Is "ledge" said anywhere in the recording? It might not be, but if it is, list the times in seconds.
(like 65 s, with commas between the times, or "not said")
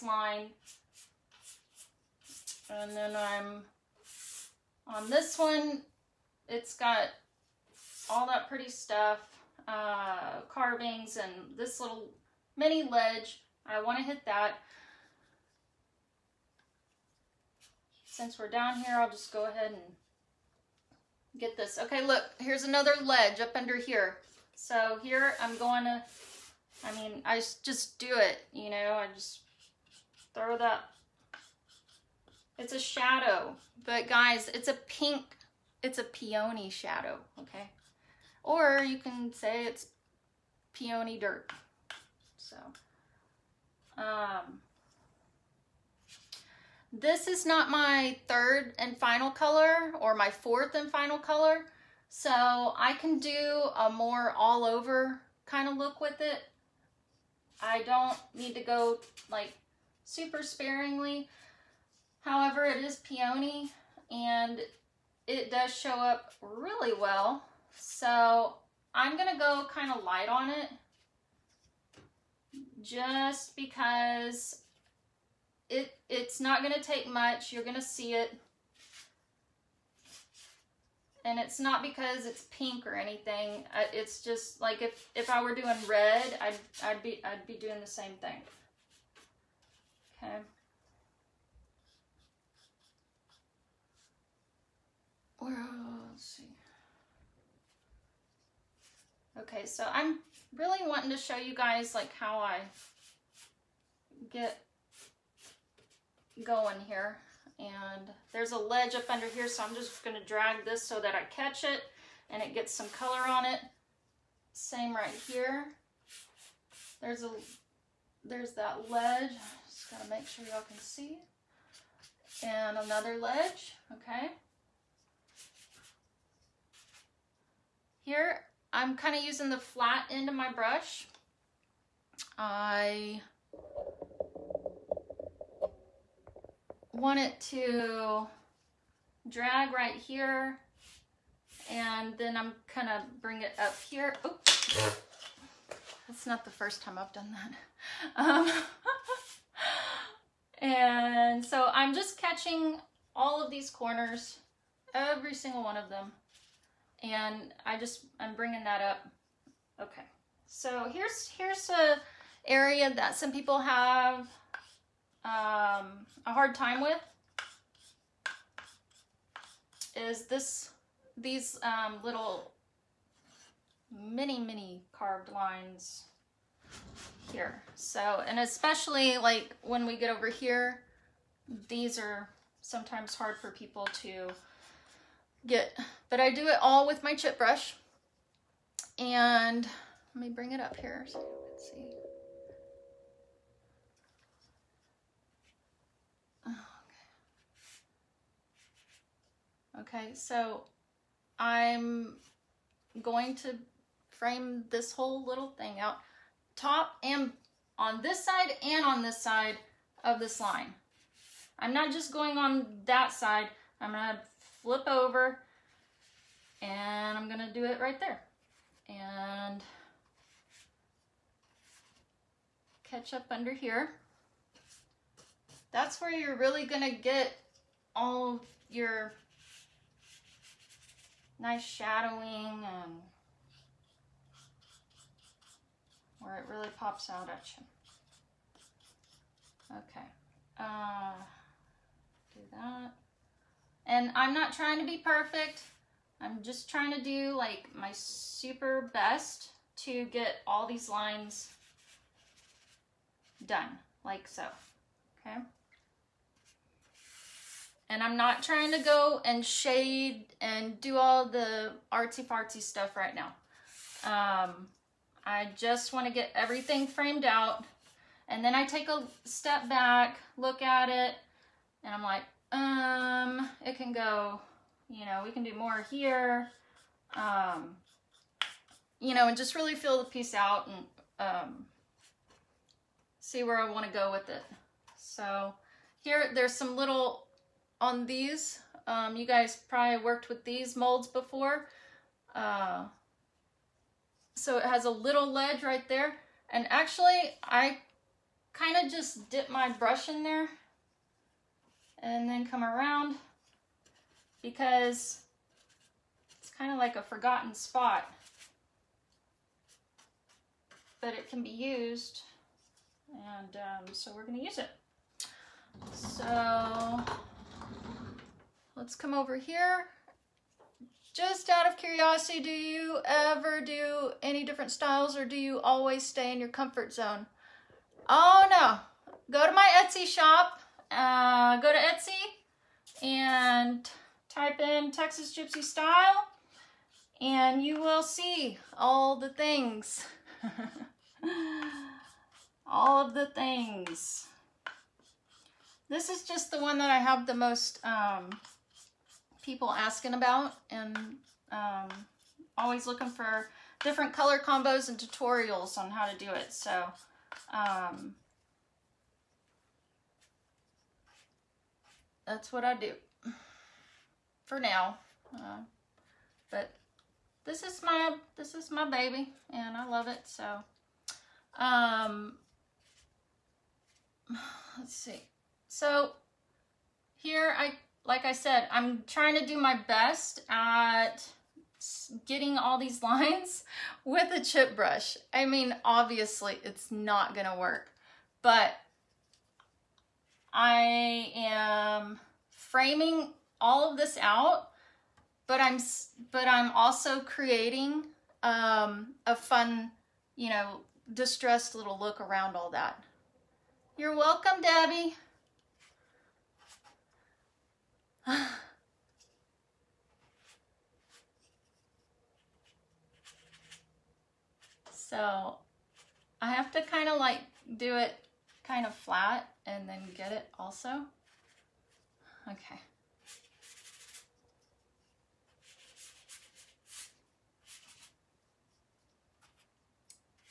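12 s, 23 s, 108 s, 118 s, 123 s, 295 s.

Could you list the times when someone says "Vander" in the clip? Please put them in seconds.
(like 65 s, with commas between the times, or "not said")
not said.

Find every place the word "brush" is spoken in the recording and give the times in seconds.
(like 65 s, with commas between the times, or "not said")
130 s, 187 s, 299 s, 384 s.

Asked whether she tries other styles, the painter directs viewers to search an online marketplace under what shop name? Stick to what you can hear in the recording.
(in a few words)
Texas Gypsy Style.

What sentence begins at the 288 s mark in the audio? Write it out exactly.
Um, you guys probably worked with these molds before.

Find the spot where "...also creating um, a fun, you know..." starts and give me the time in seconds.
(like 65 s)
396 s.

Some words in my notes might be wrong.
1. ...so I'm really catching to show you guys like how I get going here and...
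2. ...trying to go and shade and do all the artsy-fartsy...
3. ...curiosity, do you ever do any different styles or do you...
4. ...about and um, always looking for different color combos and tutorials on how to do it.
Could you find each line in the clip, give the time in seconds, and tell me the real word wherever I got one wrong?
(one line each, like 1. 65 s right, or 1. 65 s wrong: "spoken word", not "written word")
1. 99 s wrong: "wanting", not "catching"
2. 258 s right
3. 321 s right
4. 350 s right.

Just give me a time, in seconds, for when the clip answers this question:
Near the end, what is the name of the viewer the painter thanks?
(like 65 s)
403 s.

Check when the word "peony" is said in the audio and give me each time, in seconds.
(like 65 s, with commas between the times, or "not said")
36 s, 40 s, 62 s.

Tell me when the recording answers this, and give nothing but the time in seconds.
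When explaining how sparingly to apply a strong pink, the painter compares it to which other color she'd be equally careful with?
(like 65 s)
85 s.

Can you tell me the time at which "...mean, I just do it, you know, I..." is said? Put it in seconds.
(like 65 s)
26 s.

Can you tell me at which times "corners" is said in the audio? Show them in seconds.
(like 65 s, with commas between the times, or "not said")
153 s.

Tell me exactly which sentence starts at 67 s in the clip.
So I'm gonna go kind of light on it just because it it's not gonna take much.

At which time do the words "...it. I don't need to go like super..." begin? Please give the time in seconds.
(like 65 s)
56 s.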